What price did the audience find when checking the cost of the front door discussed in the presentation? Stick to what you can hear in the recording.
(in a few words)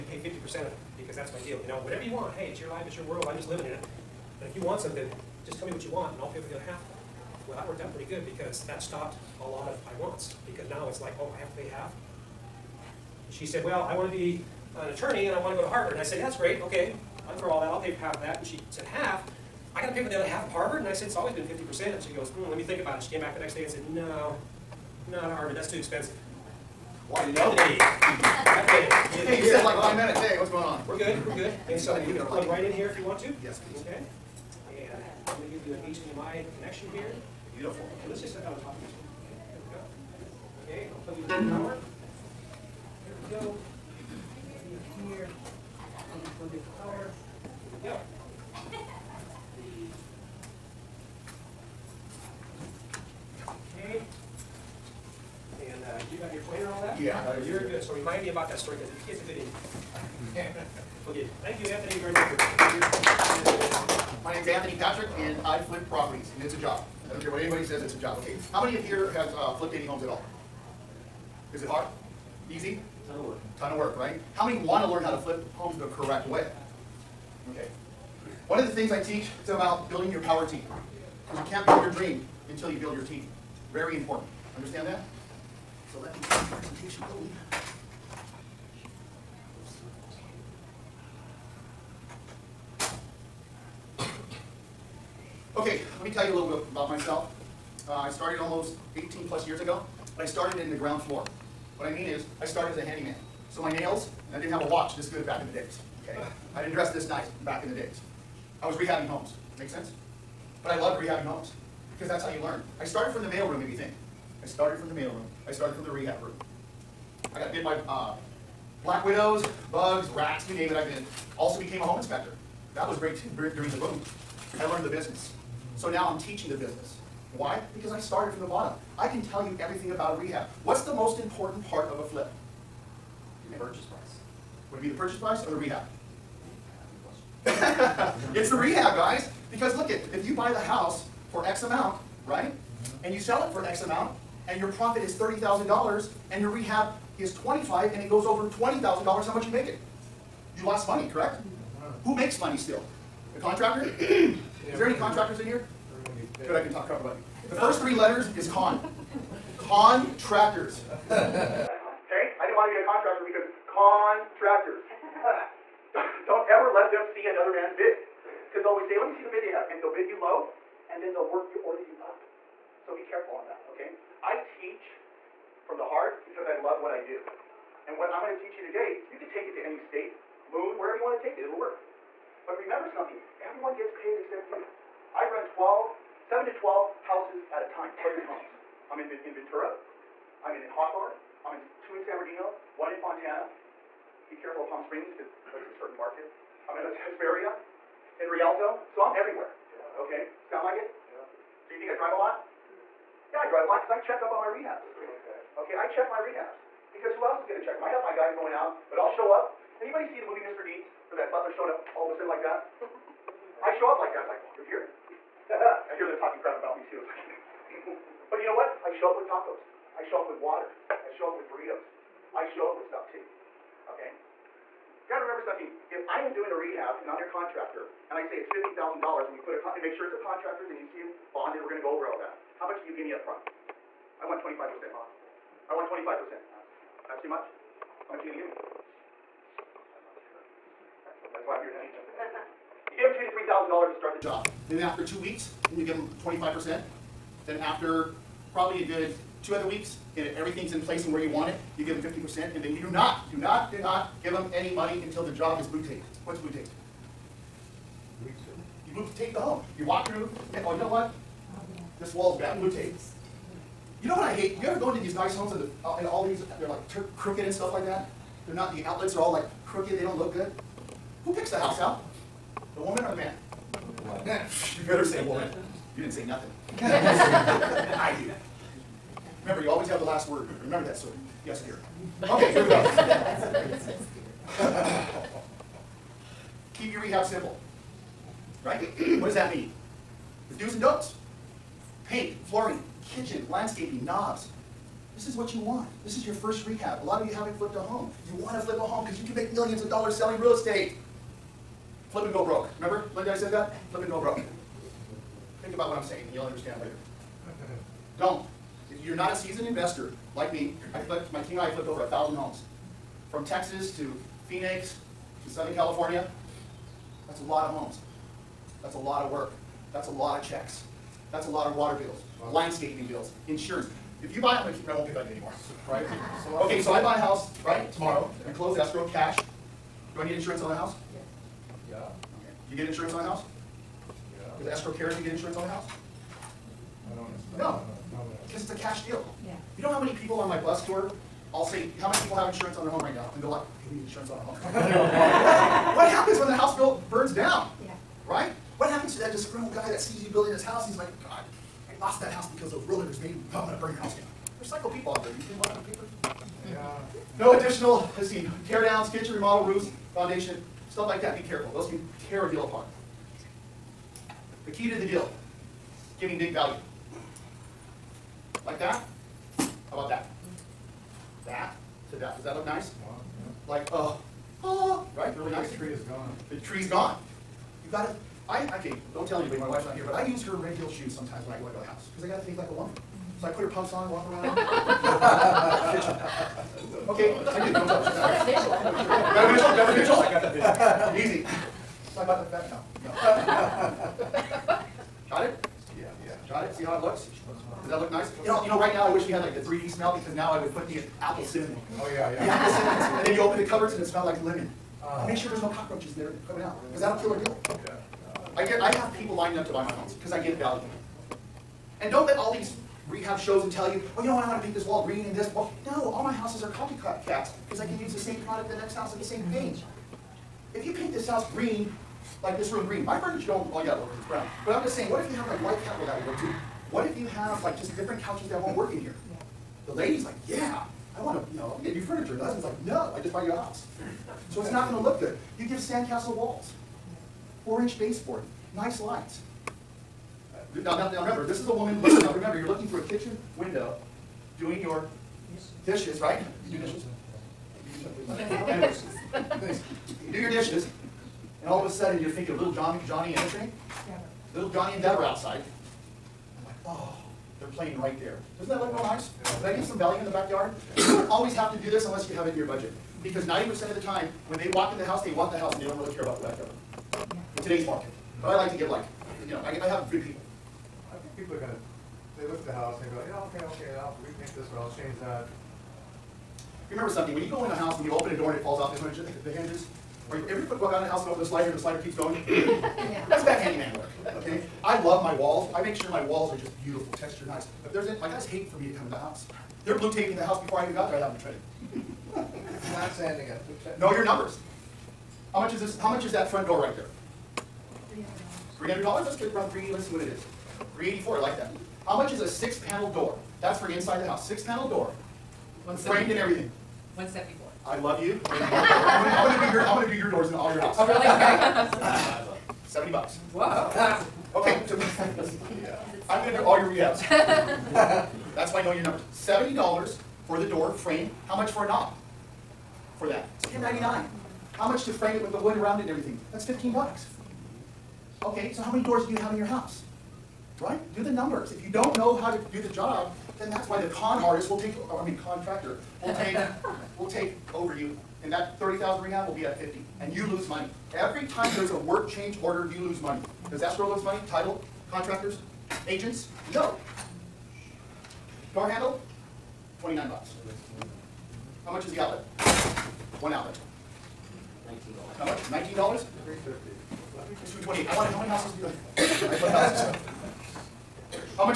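384 dollars.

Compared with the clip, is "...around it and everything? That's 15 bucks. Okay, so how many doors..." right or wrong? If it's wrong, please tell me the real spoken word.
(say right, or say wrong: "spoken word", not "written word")
right.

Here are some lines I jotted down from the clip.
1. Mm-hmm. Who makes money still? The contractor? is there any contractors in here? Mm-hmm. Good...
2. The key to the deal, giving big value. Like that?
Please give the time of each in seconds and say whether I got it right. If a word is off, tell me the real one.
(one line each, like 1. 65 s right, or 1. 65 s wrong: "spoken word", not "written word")
1. 151 s right
2. 364 s right.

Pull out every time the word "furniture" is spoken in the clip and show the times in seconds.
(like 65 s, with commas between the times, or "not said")
423 s, 431 s.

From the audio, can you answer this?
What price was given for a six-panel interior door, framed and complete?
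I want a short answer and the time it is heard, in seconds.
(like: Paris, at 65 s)
174 dollars, at 507 s.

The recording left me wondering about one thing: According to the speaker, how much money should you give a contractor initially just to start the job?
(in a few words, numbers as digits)
2,000 to 3,000 dollars.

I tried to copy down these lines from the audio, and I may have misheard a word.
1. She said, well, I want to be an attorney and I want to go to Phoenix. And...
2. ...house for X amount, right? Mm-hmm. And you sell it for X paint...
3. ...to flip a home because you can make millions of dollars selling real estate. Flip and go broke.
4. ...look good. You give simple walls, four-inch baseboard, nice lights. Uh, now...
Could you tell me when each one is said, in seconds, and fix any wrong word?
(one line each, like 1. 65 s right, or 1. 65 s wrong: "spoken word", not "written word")
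1. 13 s wrong: "Harvard", not "Phoenix"
2. 140 s wrong: "amount", not "paint"
3. 298 s right
4. 435 s wrong: "sandcastle", not "simple".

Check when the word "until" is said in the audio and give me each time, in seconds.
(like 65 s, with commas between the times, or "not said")
82 s, 255 s.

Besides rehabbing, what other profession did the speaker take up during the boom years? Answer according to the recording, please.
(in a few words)
home inspector.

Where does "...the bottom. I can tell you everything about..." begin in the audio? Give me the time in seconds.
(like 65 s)
128 s.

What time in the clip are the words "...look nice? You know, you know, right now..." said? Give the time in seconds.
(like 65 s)
397 s.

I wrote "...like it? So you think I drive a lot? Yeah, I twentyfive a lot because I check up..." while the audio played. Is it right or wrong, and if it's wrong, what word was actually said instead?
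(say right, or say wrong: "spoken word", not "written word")
wrong: "drive", not "twentyfive".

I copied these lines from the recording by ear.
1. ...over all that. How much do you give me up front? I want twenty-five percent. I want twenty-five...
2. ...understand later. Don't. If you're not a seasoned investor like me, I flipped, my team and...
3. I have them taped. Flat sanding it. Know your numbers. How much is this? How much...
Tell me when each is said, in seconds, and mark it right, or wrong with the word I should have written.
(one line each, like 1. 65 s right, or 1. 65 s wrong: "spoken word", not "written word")
1. 231 s right
2. 306 s right
3. 491 s wrong: "traded", not "taped".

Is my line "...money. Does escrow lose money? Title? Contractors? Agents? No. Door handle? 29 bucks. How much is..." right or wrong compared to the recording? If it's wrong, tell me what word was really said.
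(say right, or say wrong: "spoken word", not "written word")
right.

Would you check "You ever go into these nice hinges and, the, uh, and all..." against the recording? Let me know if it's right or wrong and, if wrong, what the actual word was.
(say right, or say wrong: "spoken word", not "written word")
wrong: "homes", not "hinges".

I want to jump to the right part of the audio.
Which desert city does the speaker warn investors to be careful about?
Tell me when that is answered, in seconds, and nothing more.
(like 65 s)
194 s.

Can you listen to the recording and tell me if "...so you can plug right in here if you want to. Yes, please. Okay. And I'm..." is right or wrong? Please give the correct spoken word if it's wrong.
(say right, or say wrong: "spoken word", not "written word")
right.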